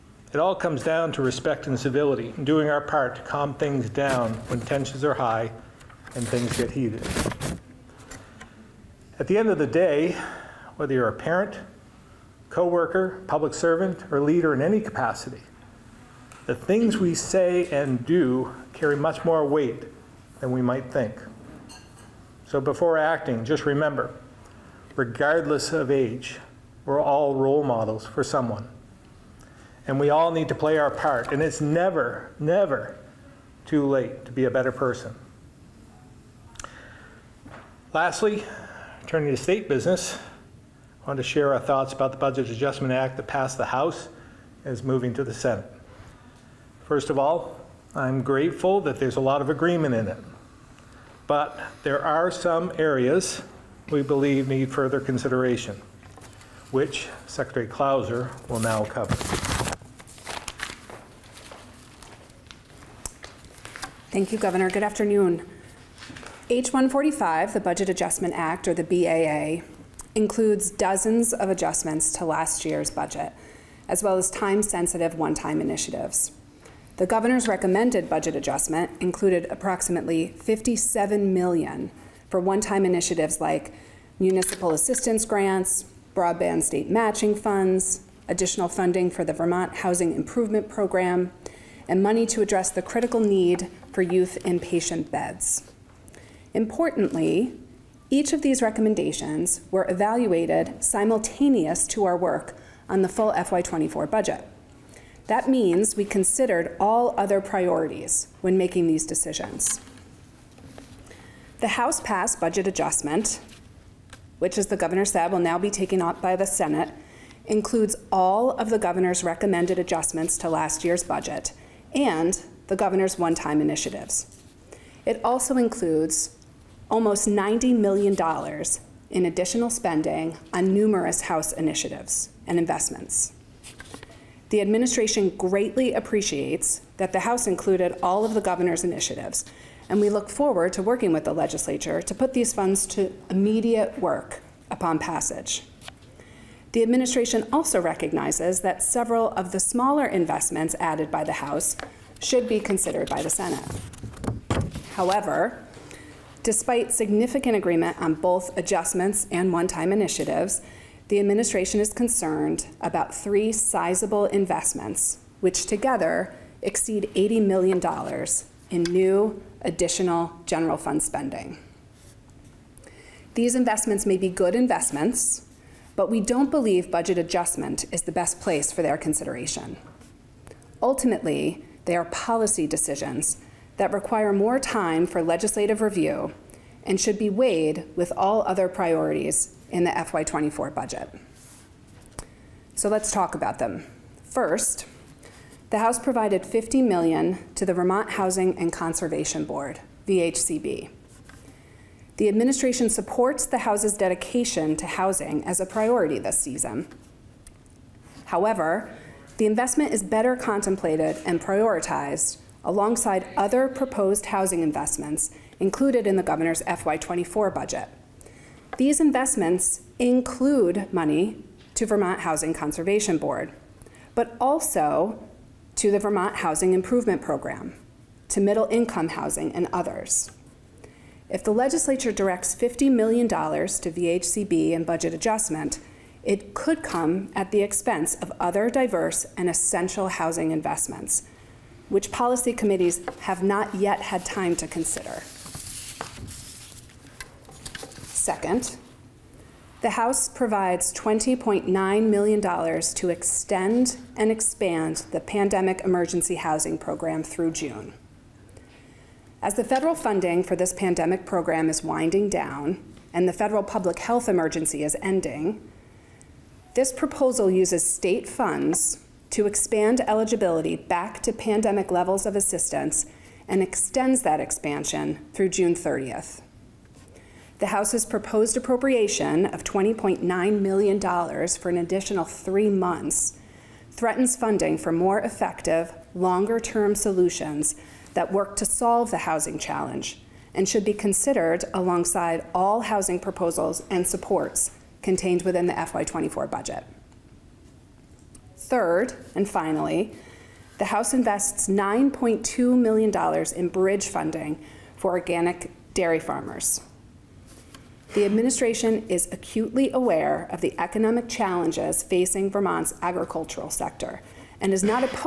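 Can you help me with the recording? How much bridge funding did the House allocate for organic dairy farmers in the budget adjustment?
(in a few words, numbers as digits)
$9.2 million.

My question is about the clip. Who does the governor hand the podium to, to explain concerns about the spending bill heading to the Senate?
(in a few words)
Secretary Clouser.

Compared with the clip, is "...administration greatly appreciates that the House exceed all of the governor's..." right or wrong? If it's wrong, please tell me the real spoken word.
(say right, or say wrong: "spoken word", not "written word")
wrong: "included", not "exceed".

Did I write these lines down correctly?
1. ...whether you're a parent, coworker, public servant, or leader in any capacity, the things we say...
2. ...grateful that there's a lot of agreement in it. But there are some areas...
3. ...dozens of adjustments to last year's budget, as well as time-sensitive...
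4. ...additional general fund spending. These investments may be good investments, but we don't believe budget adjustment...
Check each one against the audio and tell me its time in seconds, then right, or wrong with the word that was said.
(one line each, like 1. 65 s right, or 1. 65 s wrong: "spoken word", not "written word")
1. 10 s right
2. 48 s right
3. 70 s right
4. 169 s right.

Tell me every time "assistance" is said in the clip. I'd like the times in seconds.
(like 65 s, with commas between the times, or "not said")
84 s, 272 s.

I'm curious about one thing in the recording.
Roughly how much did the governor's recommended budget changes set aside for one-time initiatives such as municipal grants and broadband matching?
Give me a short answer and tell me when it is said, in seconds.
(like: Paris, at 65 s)
57 million, at 80 s.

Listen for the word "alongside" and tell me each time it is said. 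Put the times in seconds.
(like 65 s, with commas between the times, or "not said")
212 s, 291 s.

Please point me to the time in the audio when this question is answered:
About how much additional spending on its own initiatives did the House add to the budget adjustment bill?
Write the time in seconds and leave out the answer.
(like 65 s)
127 s.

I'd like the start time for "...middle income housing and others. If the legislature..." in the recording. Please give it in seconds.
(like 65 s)
228 s.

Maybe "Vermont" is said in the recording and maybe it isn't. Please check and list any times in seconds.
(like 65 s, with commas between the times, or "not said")
89 s, 197 s, 221 s, 225 s, 312 s.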